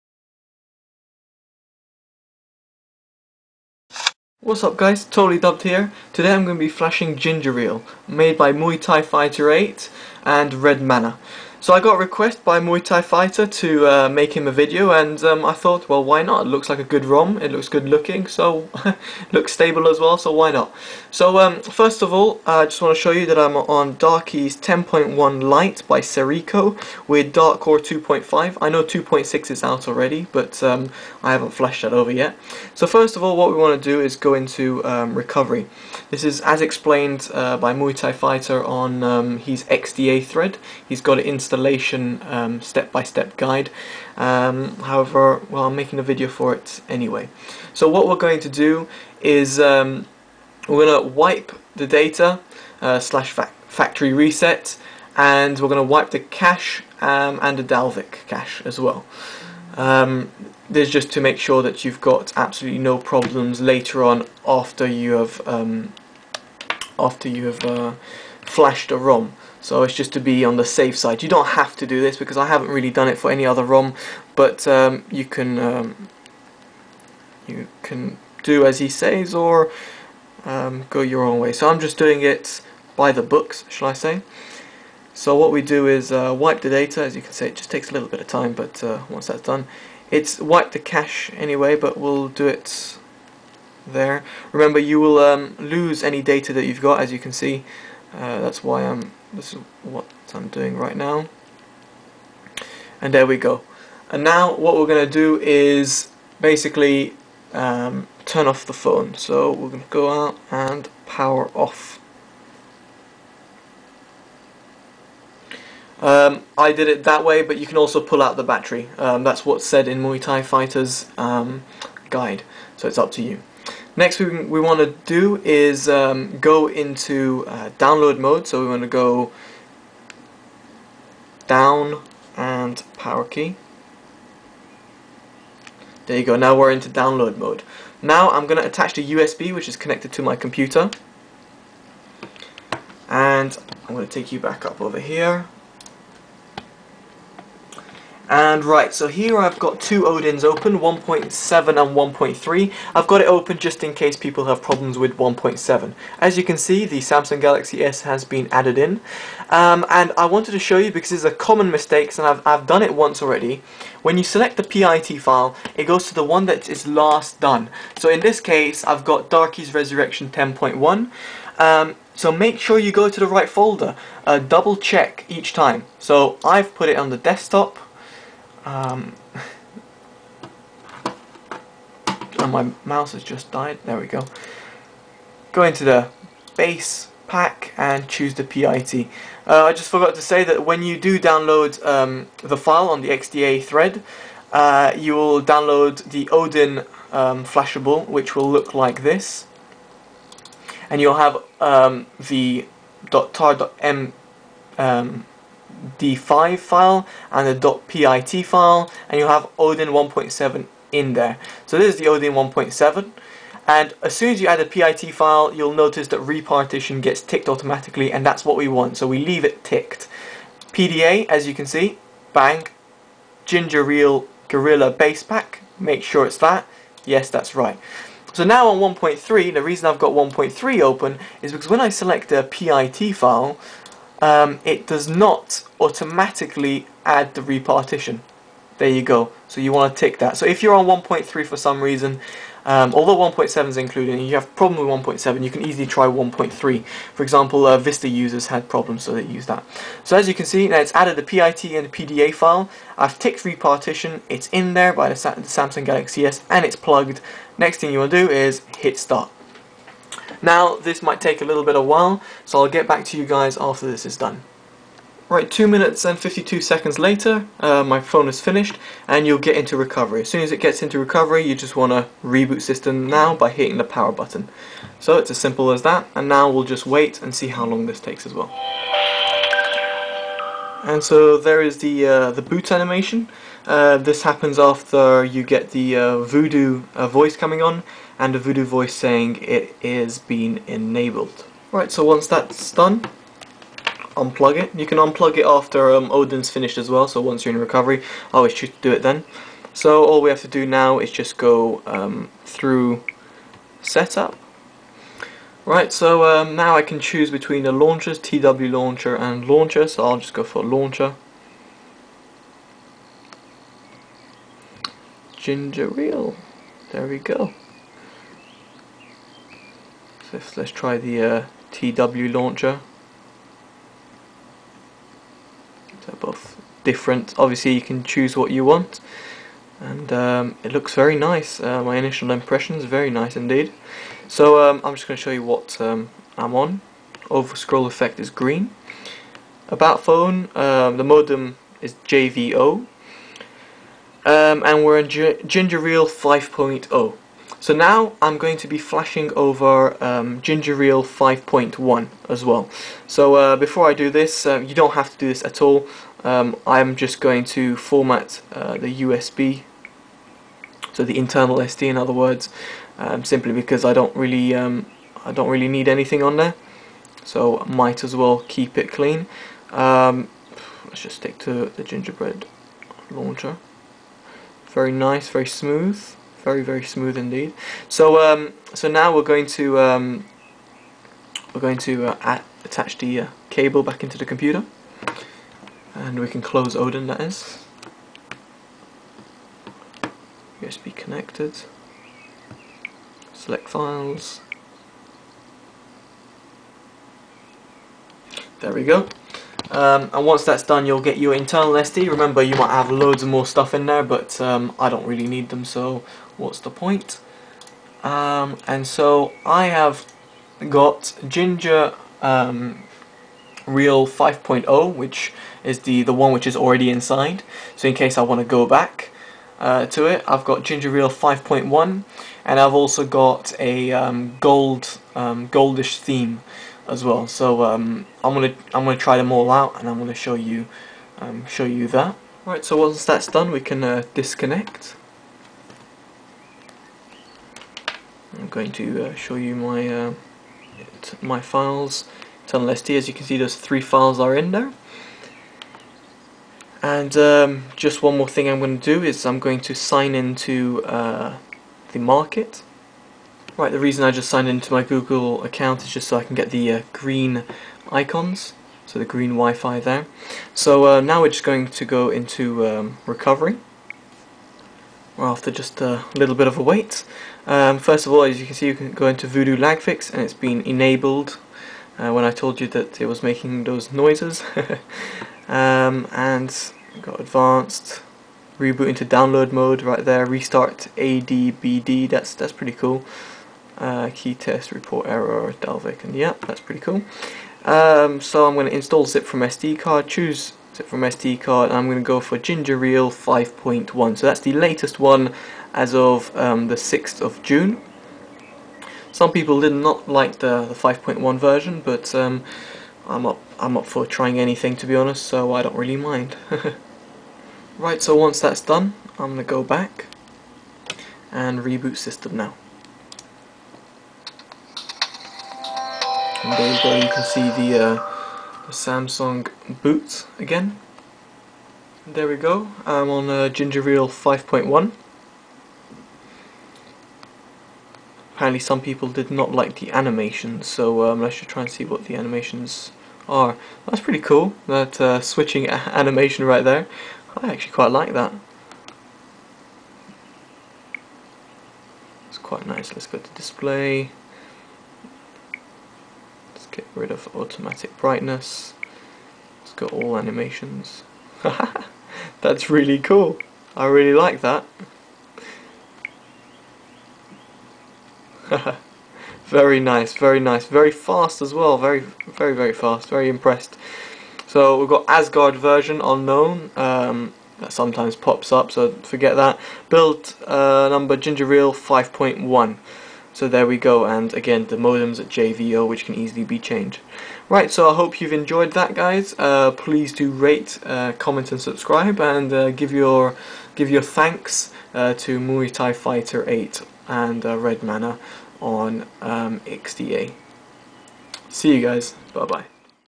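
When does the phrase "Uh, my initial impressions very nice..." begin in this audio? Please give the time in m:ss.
5:31.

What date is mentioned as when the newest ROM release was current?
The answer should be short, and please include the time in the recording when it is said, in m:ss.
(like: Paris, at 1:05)
6th of June, at 8:16.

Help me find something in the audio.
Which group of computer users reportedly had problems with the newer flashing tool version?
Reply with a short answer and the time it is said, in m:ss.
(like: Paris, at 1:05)
Vista users, at 4:07.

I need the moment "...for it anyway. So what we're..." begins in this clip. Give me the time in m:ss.
0:46.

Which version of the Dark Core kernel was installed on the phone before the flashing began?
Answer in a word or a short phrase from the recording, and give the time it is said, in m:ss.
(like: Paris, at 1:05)
2.5, at 0:27.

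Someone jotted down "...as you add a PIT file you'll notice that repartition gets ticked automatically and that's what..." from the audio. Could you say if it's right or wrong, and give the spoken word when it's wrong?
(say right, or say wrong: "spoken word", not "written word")
right.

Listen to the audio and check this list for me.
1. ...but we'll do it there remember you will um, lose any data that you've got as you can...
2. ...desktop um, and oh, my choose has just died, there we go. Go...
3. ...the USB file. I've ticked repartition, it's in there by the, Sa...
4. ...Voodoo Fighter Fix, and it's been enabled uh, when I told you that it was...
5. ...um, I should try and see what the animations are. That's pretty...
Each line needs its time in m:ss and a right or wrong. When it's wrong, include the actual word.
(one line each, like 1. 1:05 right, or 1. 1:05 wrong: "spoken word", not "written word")
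1. 1:31 right
2. 2:57 wrong: "mouse", not "choose"
3. 4:11 wrong: "PDA", not "USB"
4. 7:49 wrong: "Lag", not "Fighter"
5. 8:51 right.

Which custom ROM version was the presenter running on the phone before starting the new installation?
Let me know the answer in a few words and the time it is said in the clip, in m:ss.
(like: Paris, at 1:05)
Darky's 10.1 Lite, at 0:23.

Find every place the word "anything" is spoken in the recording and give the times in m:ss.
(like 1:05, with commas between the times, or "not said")
6:05, 8:24.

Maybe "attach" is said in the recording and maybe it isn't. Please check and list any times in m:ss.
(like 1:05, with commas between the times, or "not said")
2:18, 6:22.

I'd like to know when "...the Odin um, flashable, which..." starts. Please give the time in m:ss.
3:16.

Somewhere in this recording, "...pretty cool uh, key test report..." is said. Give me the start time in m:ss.
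8:02.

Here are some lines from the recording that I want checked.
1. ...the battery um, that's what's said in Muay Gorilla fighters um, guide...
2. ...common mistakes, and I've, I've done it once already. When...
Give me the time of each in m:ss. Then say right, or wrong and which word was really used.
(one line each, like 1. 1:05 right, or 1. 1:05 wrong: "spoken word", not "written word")
1. 1:58 wrong: "Thai", not "Gorilla"
2. 2:41 right.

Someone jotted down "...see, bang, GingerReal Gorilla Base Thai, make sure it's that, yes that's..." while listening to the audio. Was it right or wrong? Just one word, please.
wrong.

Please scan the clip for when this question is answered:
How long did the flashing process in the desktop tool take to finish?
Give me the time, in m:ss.
4:25.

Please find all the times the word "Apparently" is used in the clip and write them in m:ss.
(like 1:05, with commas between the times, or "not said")
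8:48.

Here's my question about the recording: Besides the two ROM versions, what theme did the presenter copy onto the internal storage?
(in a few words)
goldish theme.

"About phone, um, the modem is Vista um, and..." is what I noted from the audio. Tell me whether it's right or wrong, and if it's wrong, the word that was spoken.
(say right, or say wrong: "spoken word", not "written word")
wrong: "JVO", not "Vista".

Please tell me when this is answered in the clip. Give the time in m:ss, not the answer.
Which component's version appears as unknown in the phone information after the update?
9:25.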